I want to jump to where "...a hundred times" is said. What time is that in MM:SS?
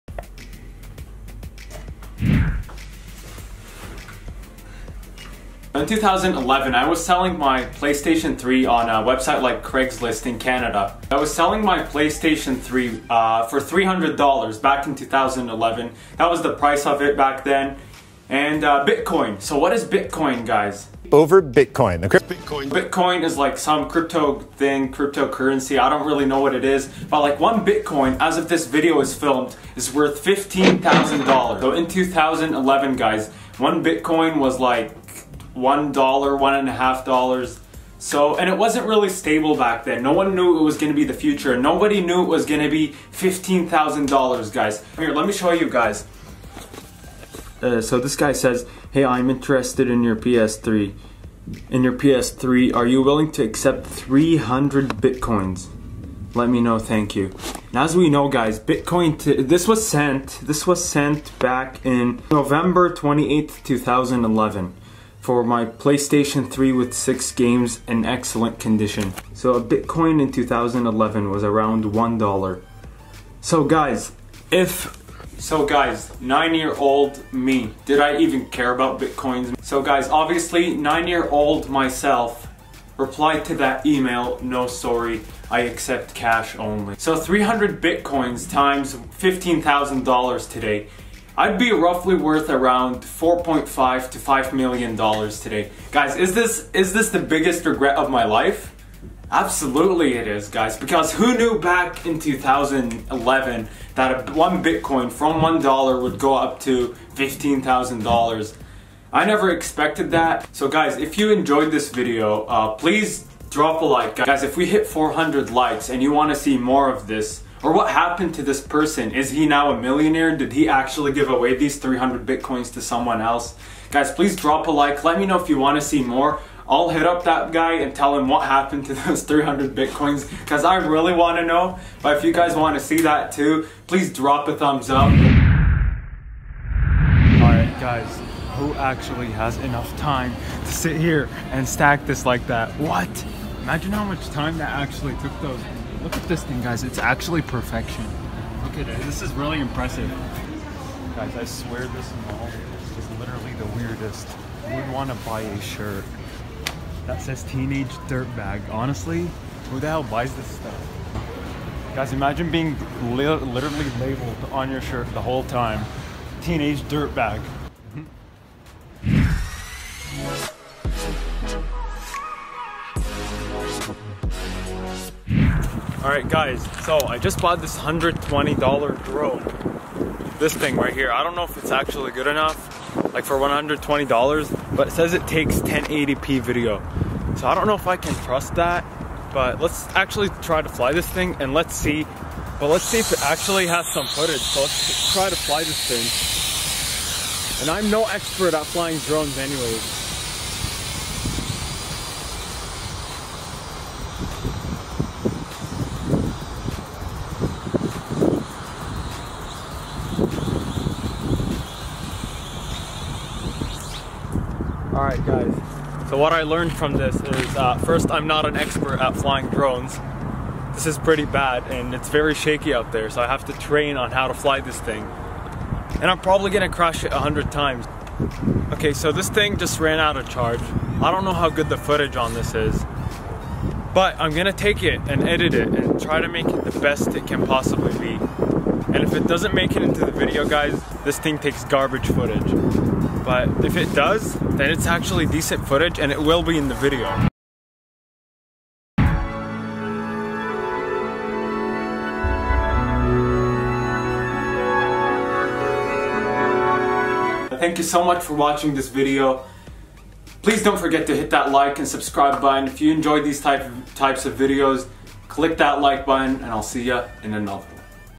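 03:47.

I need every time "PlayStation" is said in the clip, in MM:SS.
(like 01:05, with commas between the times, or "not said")
00:07, 00:11, 01:05.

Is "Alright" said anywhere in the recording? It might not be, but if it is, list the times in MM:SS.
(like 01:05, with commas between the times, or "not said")
02:17, 02:56.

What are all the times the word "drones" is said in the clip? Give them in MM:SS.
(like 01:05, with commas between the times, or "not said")
02:59, 03:19, 03:39.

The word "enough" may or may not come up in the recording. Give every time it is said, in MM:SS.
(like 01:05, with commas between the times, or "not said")
02:19, 03:02.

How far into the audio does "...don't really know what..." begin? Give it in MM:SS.
00:25.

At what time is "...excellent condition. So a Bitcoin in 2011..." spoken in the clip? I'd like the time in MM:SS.
01:08.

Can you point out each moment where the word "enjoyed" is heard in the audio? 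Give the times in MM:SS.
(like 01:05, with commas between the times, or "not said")
01:51, 04:22.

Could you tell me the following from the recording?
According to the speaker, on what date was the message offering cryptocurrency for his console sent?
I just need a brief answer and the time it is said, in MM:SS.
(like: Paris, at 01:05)
November 28th, 2011, at 01:02.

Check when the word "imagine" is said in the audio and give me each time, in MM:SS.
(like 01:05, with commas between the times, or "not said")
02:23, 02:42.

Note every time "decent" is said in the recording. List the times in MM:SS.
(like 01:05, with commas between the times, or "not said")
04:05.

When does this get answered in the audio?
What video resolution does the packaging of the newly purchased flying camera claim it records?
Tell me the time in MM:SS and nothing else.
03:05.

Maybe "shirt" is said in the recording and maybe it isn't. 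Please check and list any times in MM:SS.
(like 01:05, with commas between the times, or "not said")
02:35, 02:44.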